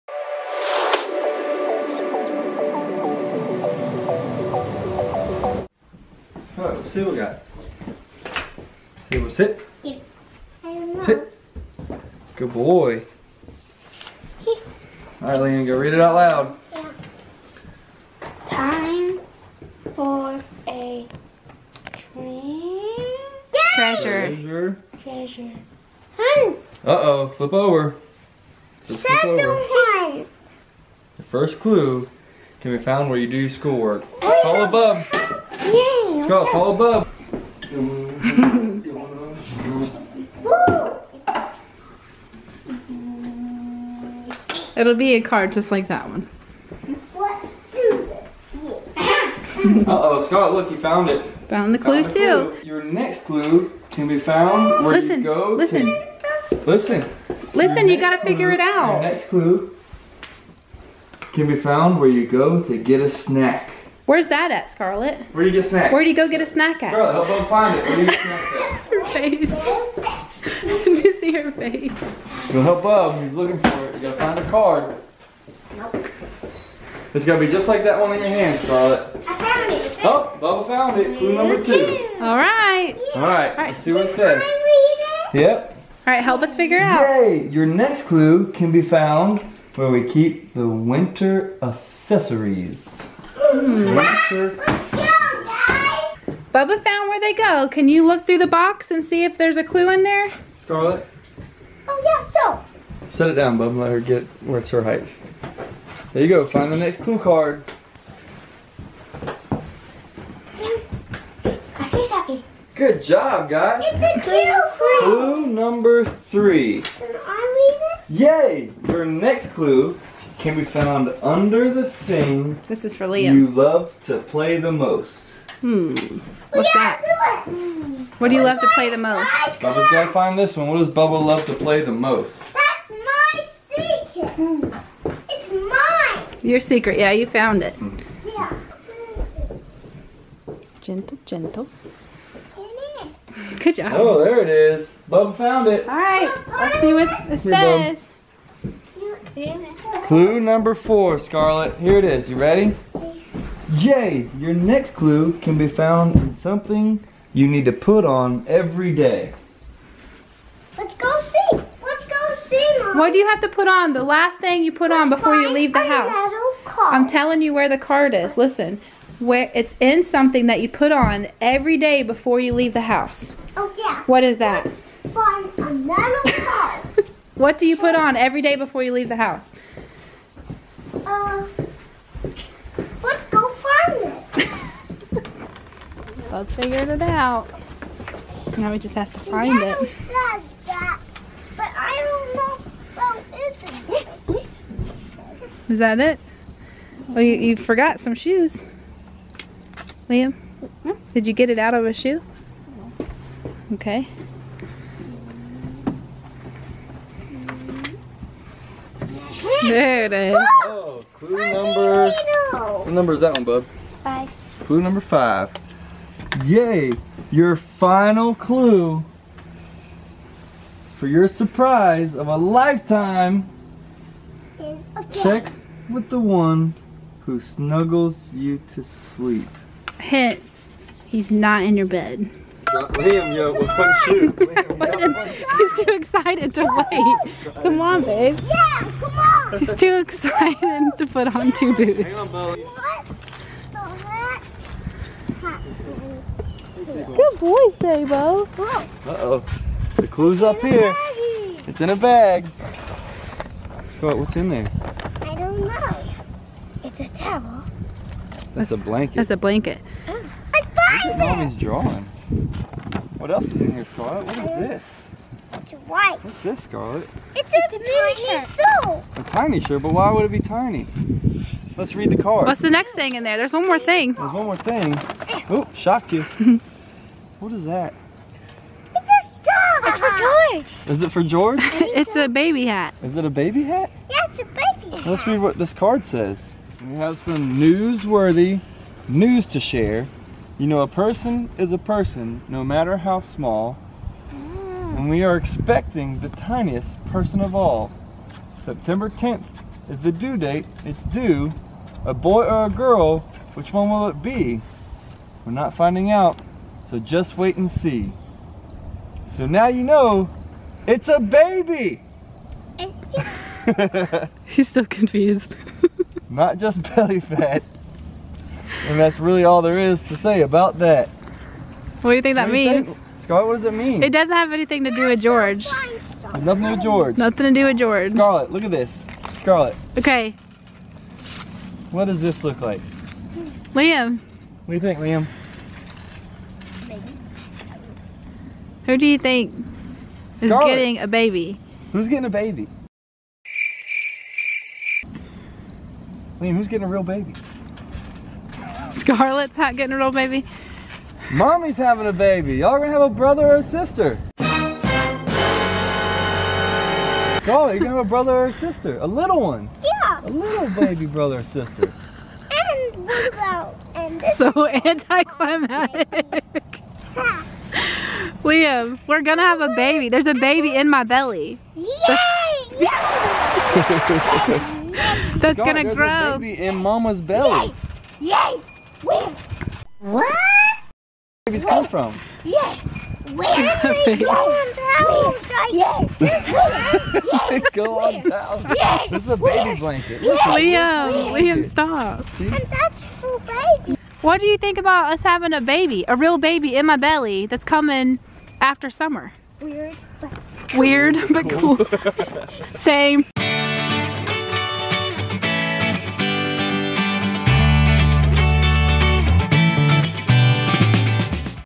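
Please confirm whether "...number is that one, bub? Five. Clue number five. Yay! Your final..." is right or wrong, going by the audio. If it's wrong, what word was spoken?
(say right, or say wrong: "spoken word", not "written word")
right.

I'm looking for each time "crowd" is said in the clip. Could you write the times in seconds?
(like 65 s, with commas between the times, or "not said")
not said.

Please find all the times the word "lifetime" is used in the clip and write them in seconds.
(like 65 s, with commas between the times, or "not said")
222 s.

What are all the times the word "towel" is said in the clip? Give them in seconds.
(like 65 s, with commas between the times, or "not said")
257 s.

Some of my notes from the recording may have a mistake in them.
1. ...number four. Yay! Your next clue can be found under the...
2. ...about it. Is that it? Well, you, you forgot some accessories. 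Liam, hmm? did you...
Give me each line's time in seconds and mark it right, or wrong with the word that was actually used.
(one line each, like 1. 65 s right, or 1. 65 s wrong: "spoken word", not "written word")
1. 115 s wrong: "three", not "four"
2. 194 s wrong: "shoes", not "accessories".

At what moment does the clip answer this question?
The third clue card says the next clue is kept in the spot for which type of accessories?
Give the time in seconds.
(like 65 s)
90 s.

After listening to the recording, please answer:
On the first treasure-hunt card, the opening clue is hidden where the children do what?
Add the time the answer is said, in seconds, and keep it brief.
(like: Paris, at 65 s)
Schoolwork, at 33 s.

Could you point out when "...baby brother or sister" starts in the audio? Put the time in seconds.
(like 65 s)
360 s.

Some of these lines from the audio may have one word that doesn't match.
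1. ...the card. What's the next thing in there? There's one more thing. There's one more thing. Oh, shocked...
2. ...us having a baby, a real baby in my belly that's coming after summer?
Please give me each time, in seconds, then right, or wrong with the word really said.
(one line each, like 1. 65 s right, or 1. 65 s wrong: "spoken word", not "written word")
1. 272 s right
2. 395 s right.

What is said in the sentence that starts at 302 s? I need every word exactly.
A boy or a girl, which one will it be?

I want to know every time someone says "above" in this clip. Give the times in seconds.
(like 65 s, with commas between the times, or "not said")
34 s.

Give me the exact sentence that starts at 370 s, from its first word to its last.
There's a baby in my belly.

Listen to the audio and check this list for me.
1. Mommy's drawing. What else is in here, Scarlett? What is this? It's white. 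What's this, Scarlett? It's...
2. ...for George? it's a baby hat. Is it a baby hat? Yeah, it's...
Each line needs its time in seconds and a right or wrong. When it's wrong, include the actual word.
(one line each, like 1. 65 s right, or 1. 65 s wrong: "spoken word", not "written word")
1. 261 s right
2. 281 s right.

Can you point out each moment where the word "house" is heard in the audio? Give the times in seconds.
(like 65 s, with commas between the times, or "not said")
165 s, 172 s, 179 s.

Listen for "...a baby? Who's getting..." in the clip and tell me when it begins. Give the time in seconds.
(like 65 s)
340 s.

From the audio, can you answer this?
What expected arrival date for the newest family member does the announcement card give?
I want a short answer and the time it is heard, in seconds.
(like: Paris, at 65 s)
September 10th, at 298 s.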